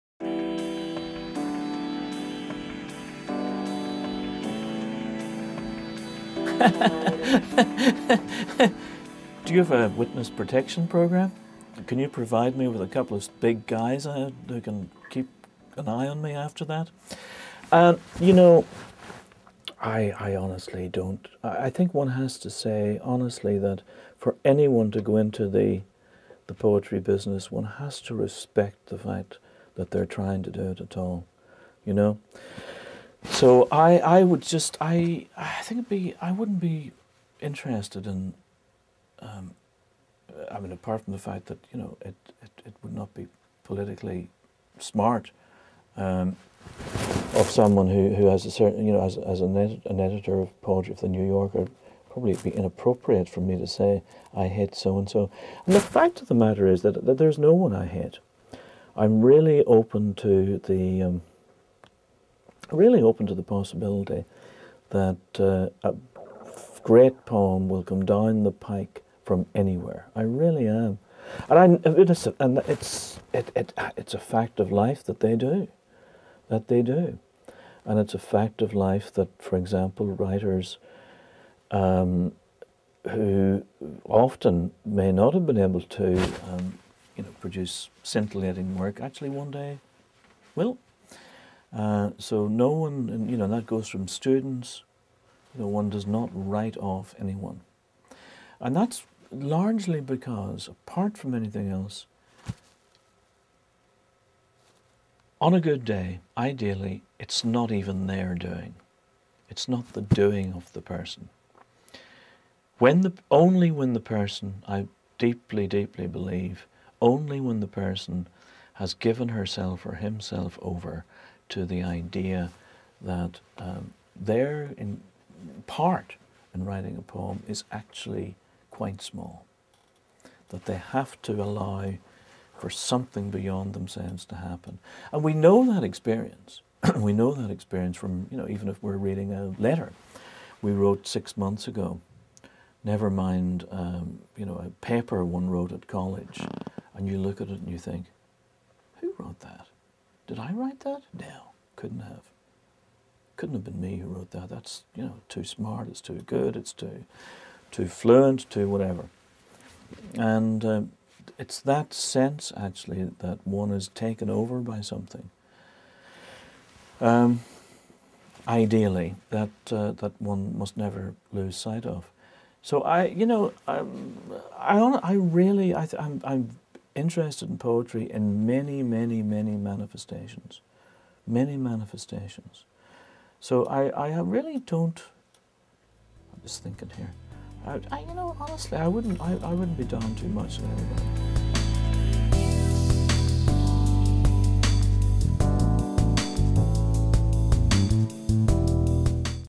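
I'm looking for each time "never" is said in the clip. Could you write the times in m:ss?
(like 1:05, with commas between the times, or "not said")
2:22, 2:50.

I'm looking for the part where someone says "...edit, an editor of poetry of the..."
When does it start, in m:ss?
0:49.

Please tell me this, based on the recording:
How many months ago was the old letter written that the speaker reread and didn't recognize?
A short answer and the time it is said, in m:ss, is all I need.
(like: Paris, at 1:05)
6, at 2:21.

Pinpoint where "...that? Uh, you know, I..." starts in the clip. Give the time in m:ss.
0:16.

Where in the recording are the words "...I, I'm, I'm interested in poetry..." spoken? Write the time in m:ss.
2:55.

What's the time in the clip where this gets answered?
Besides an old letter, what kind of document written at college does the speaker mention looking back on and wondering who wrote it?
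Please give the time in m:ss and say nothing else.
2:24.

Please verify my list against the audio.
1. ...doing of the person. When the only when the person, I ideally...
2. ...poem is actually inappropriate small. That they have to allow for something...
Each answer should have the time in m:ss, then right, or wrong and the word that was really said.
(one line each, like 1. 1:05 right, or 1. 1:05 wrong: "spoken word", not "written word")
1. 1:50 wrong: "deeply", not "ideally"
2. 2:07 wrong: "quite", not "inappropriate".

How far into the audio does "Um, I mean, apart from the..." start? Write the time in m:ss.
0:39.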